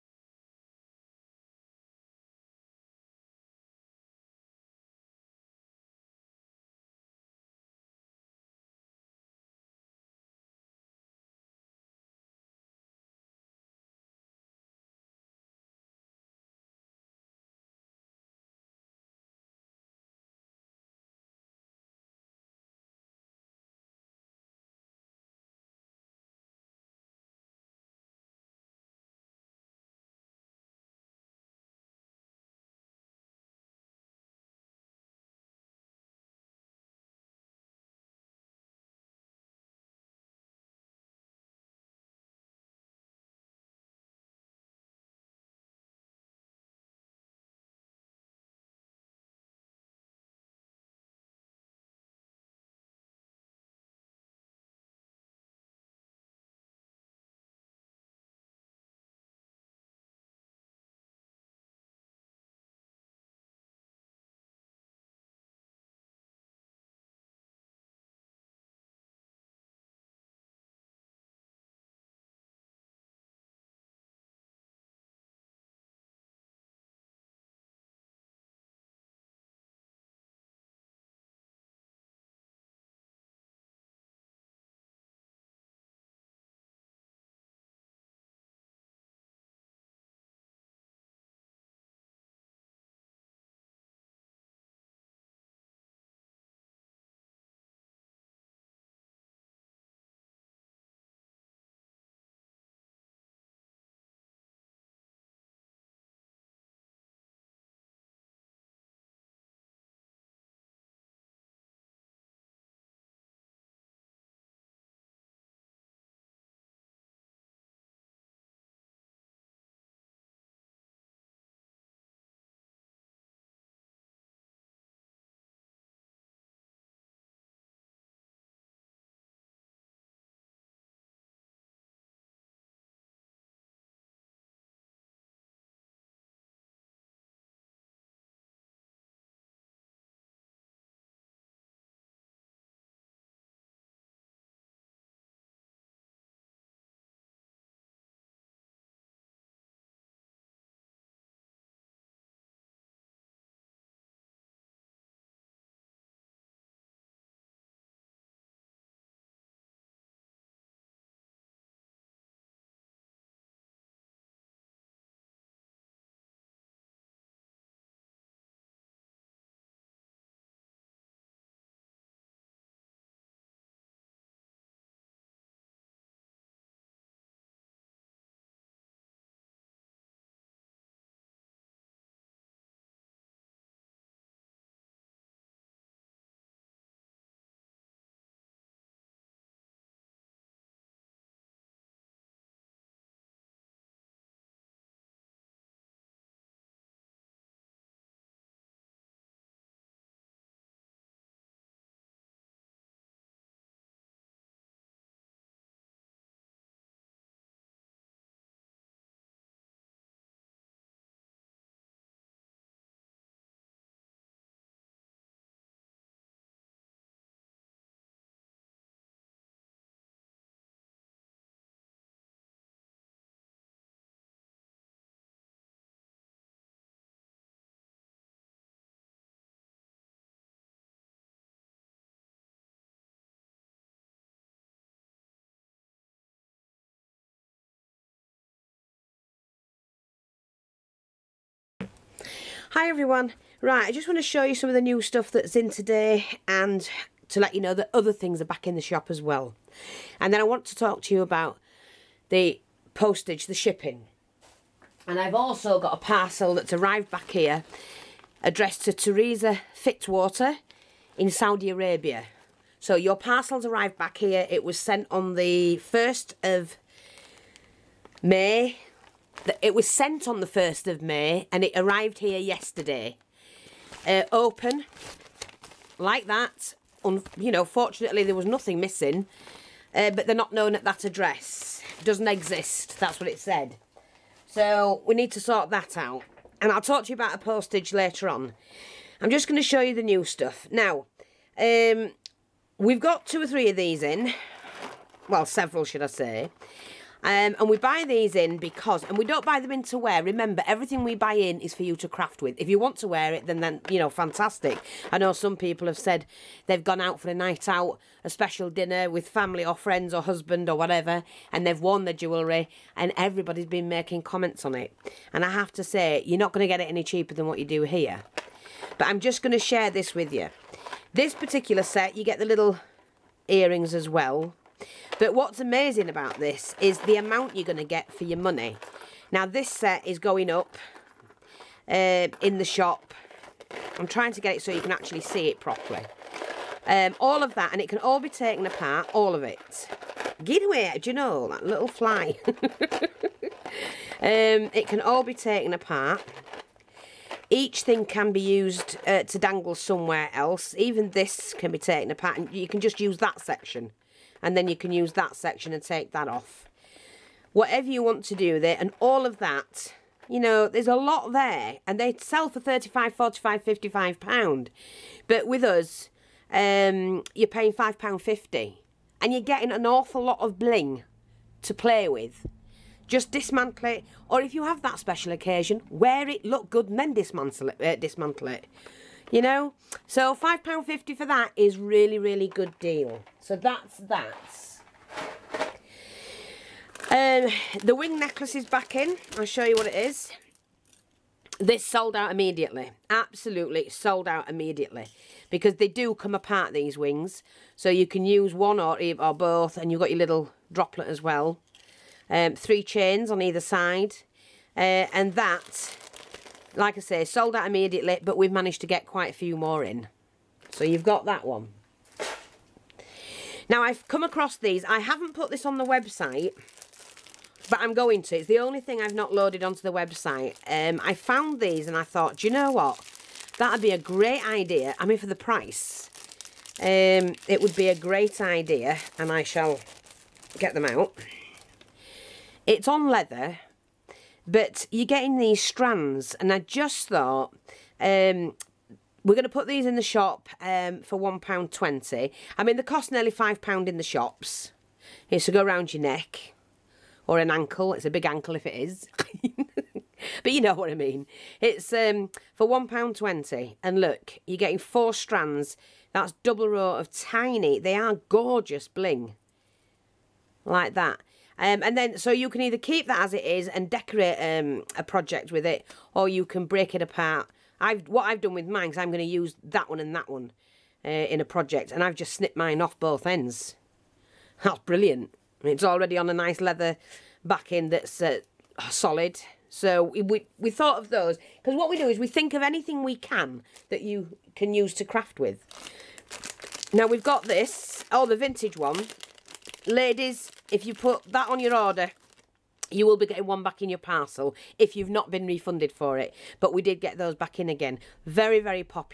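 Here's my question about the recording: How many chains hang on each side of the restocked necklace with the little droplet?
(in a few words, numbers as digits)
3.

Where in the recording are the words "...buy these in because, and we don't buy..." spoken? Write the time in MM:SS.
04:57.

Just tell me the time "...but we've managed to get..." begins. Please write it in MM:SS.
06:48.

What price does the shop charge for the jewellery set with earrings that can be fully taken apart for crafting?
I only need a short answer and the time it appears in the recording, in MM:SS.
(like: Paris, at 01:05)
£5.50, at 06:07.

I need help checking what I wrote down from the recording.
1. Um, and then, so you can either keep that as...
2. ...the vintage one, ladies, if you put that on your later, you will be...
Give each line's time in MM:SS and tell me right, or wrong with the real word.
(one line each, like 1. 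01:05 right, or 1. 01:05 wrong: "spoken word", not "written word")
1. 07:41 right
2. 08:08 wrong: "order", not "later".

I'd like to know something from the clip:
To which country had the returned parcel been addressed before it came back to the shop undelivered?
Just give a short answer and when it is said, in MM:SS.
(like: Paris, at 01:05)
Saudi Arabia, at 04:21.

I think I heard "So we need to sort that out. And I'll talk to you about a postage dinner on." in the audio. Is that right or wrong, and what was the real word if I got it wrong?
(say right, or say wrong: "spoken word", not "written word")
wrong: "later", not "dinner".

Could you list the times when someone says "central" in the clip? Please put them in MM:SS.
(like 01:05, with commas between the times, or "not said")
not said.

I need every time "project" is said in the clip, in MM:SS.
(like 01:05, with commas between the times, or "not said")
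07:45, 07:51.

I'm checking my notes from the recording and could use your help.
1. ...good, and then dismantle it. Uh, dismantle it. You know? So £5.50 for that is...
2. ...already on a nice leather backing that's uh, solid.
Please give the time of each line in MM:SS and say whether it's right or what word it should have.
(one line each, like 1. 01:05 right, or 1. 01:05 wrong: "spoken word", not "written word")
1. 06:16 right
2. 07:55 right.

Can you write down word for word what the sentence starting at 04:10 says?
And then I want to talk to you about the postage, the shipping.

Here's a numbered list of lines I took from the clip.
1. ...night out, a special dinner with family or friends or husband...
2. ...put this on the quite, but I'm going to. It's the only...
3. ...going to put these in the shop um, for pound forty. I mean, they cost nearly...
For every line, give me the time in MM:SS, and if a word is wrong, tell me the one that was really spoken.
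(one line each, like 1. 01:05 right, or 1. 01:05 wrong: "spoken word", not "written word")
1. 05:07 right
2. 06:55 wrong: "website", not "quite"
3. 07:19 wrong: "twenty", not "forty".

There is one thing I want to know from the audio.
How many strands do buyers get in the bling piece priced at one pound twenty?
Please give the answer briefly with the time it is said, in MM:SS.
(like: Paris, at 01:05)
4, at 07:34.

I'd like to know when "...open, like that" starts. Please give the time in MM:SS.
04:34.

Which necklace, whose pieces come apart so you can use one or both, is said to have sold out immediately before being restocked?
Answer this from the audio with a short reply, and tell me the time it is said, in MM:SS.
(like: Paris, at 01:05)
wing necklace, at 06:27.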